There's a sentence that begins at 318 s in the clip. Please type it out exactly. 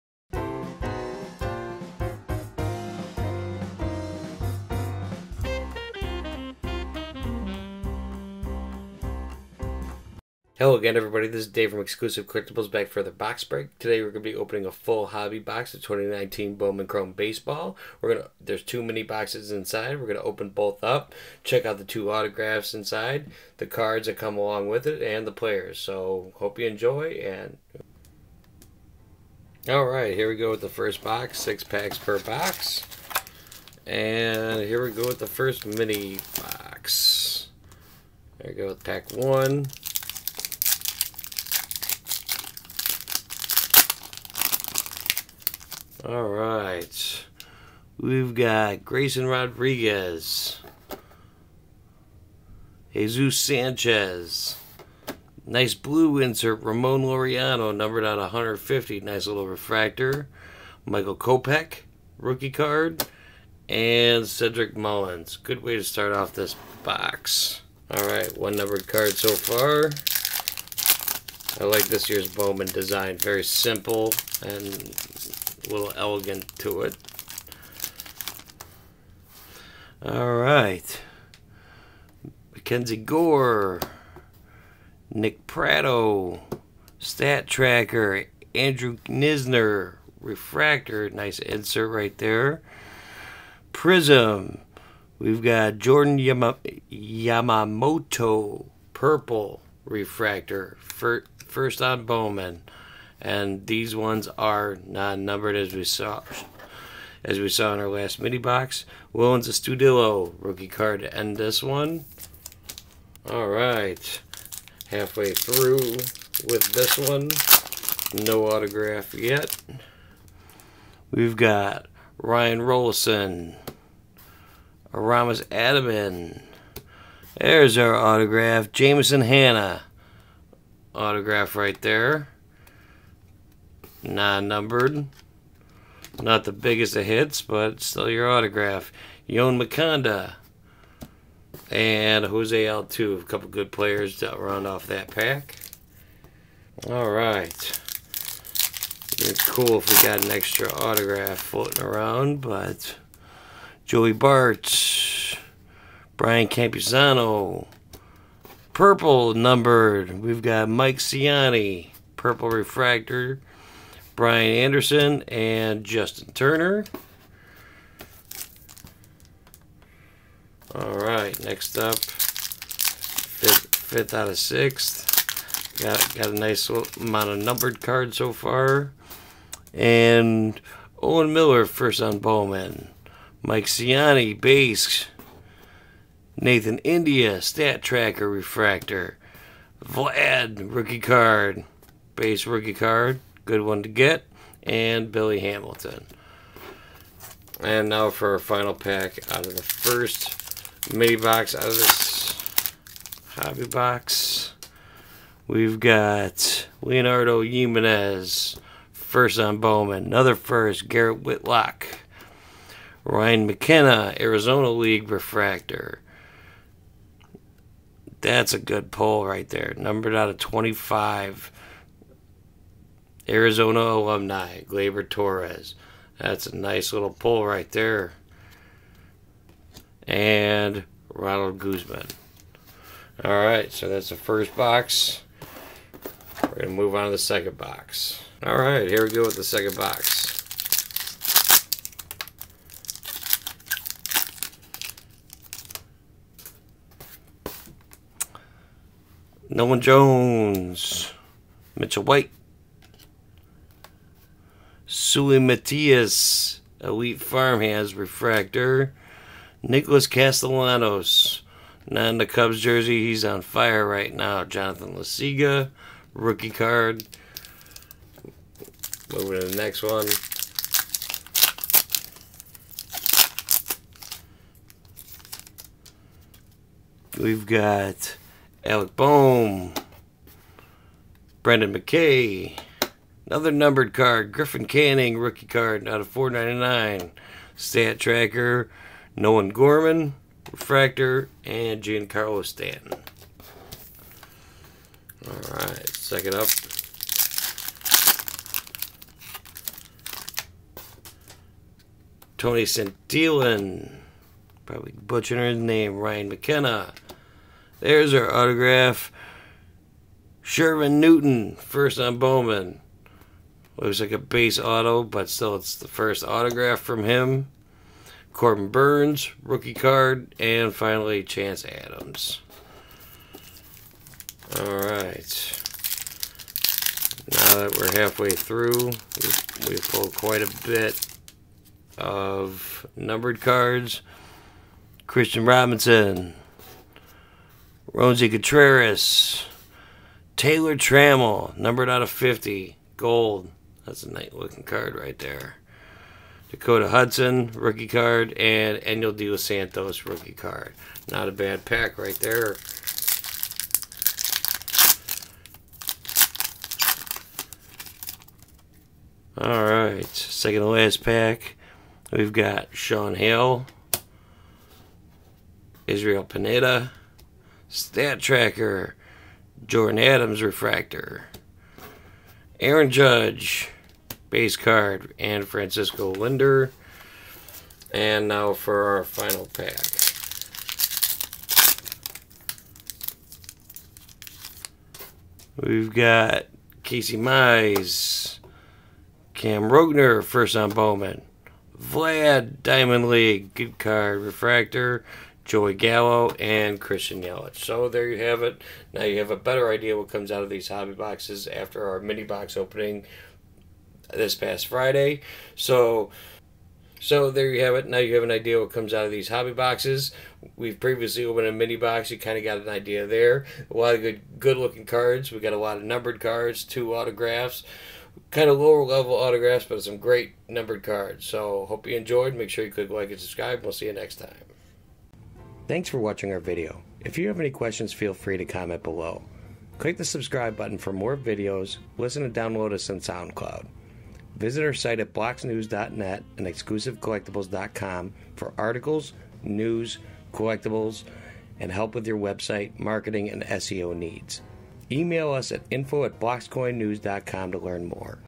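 Corbin Burnes, rookie card, and finally Chance Adams.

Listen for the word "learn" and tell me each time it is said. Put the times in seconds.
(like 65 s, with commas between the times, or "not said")
447 s.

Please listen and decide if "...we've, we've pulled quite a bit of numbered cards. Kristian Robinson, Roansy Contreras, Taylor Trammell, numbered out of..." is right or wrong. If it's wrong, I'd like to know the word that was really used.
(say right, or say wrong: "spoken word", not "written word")
right.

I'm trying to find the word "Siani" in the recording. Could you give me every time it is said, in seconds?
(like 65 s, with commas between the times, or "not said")
160 s, 183 s.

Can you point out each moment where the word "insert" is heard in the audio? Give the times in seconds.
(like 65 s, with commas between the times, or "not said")
56 s, 91 s.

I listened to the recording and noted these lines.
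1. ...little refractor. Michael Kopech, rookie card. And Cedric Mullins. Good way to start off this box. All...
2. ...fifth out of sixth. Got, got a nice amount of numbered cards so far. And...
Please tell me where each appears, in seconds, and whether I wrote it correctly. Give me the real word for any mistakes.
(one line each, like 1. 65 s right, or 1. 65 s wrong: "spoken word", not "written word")
1. 59 s right
2. 173 s right.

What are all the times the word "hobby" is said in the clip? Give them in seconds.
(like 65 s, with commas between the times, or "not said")
15 s, 203 s, 400 s, 409 s.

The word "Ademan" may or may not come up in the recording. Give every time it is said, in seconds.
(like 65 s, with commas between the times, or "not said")
125 s.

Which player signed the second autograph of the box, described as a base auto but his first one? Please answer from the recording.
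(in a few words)
Shervyen Newton.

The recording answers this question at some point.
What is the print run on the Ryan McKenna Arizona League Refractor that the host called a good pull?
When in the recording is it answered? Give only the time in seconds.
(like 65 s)
219 s.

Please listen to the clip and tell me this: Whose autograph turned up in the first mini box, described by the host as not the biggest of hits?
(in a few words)
Jameson Hannah.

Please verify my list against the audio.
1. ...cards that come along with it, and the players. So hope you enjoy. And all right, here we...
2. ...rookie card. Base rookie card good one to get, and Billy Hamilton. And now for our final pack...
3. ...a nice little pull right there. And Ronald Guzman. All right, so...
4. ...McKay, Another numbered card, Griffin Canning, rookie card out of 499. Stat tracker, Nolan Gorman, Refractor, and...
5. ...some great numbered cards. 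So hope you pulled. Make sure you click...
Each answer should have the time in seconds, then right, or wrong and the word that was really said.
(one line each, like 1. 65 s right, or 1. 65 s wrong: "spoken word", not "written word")
1. 23 s right
2. 190 s right
3. 226 s right
4. 281 s right
5. 419 s wrong: "enjoyed", not "pulled".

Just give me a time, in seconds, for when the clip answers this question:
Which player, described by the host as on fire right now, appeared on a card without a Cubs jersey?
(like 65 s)
259 s.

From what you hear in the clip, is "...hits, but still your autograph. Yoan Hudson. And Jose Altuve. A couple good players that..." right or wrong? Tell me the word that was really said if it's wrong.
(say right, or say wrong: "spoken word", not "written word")
wrong: "Moncada", not "Hudson".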